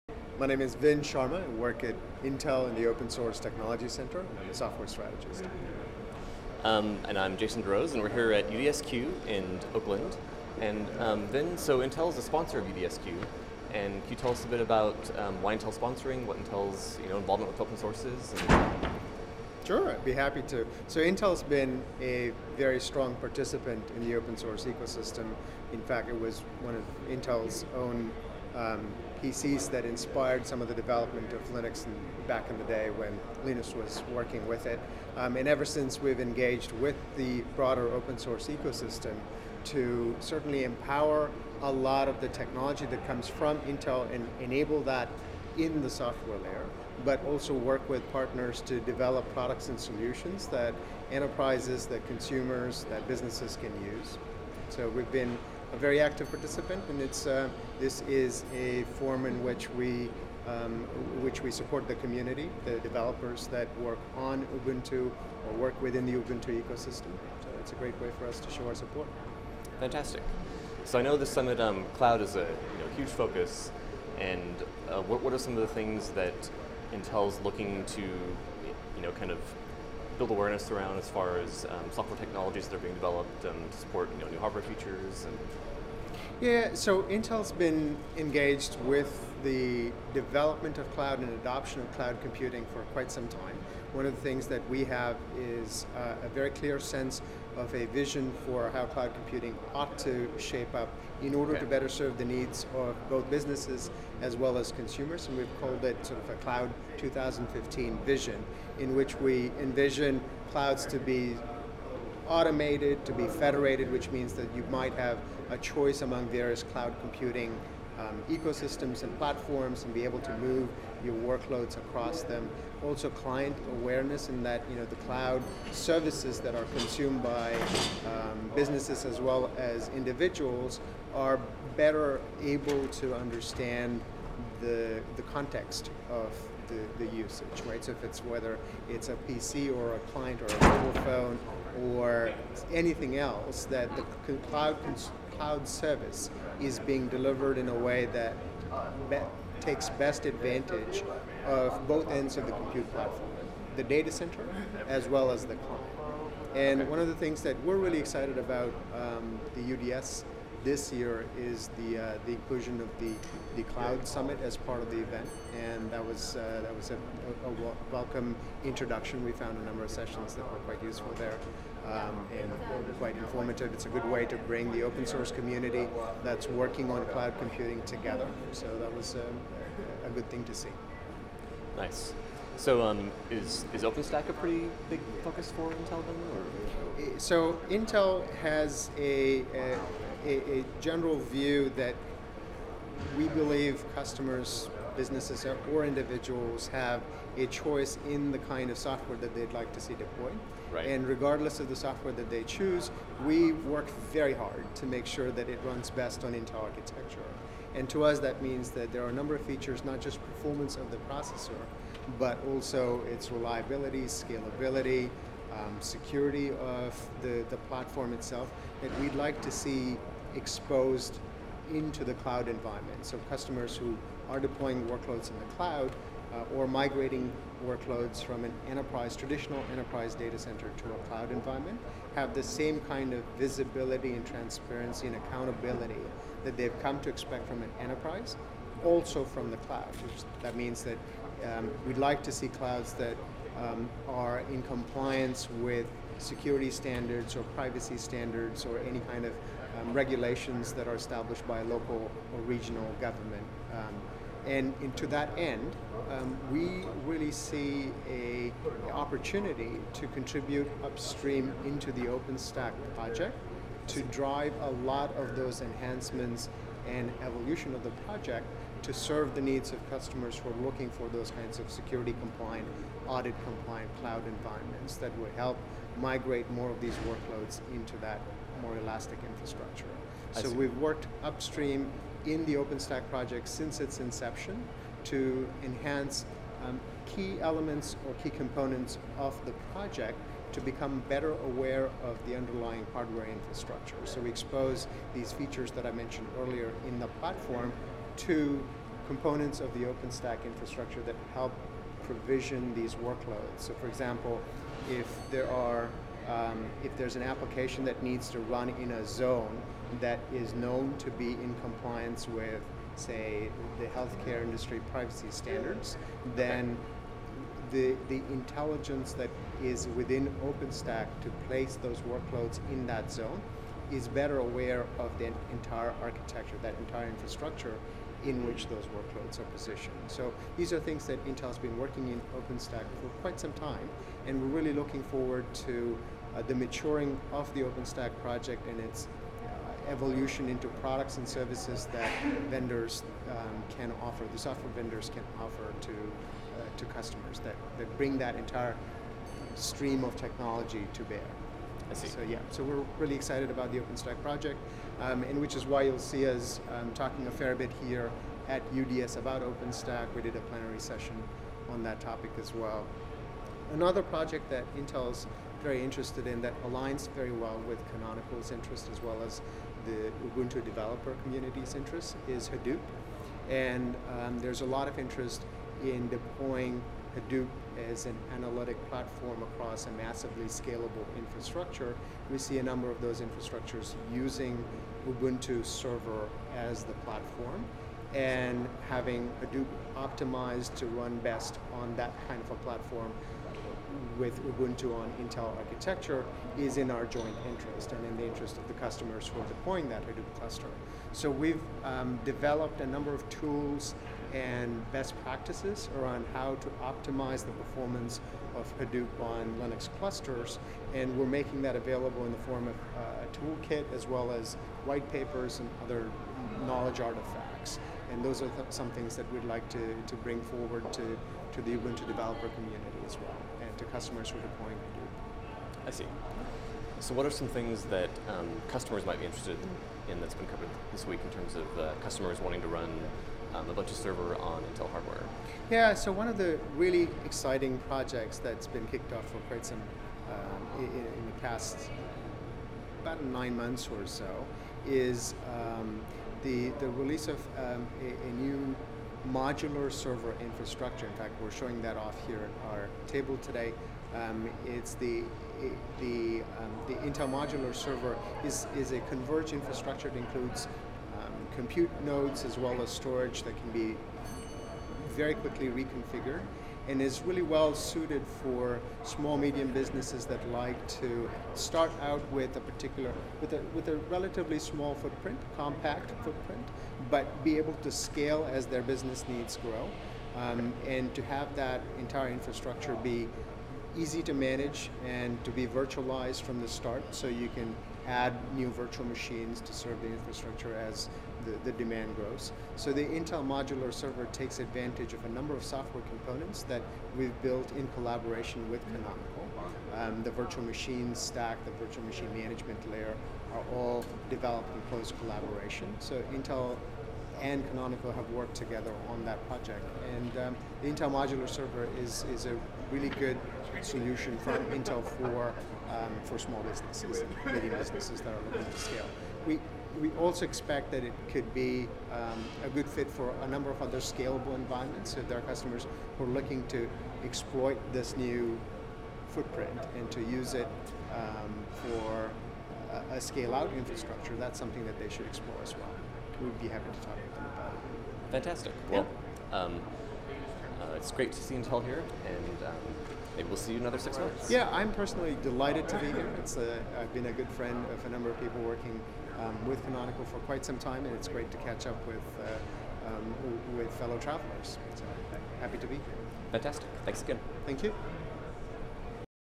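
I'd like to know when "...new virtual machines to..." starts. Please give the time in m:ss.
8:08.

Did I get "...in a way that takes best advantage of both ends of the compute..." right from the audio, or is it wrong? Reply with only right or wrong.
right.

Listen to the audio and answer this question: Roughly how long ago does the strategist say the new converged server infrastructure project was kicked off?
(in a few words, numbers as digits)
about 9 months.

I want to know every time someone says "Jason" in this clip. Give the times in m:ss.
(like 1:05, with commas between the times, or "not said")
0:07.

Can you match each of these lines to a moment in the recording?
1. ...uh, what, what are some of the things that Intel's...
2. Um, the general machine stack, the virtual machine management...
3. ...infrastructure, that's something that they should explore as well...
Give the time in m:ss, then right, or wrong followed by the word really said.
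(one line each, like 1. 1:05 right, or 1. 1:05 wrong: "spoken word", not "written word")
1. 1:14 right
2. 8:19 wrong: "virtual", not "general"
3. 8:53 right.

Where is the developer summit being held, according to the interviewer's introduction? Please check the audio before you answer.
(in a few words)
Oakland.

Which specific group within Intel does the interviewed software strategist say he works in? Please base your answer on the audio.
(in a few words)
Open Source Technology Center.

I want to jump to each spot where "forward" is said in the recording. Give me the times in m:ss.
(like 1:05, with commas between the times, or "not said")
5:35, 7:00.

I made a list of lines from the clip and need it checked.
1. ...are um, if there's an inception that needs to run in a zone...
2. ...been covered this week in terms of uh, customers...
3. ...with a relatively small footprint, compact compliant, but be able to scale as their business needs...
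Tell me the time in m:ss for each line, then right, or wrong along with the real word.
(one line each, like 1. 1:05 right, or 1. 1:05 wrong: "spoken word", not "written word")
1. 5:05 wrong: "application", not "inception"
2. 7:10 right
3. 7:53 wrong: "footprint", not "compliant".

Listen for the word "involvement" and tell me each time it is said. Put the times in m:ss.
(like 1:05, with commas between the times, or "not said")
0:17.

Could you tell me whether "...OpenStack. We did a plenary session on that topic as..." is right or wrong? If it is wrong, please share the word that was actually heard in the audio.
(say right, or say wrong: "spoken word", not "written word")
right.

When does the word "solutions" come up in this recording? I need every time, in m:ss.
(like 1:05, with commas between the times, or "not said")
0:49, 8:33.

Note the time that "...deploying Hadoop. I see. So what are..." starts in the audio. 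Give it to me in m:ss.
7:04.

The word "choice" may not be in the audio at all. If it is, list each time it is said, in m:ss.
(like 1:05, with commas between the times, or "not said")
1:55, 3:17.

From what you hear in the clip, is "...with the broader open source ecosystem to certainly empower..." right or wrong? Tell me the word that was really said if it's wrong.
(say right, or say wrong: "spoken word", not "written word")
right.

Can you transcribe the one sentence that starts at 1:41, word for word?
to better serve the needs of both businesses as well as consumers.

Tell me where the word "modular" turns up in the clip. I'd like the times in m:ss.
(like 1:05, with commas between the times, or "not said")
7:29, 7:37, 8:13, 8:31.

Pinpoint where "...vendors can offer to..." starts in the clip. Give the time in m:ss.
5:44.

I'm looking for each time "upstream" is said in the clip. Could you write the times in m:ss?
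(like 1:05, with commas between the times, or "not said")
4:20, 4:41.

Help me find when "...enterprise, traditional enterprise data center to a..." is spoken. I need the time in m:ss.
3:48.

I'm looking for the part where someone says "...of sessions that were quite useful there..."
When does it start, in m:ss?
2:49.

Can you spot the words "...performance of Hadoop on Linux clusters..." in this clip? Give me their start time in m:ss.
6:47.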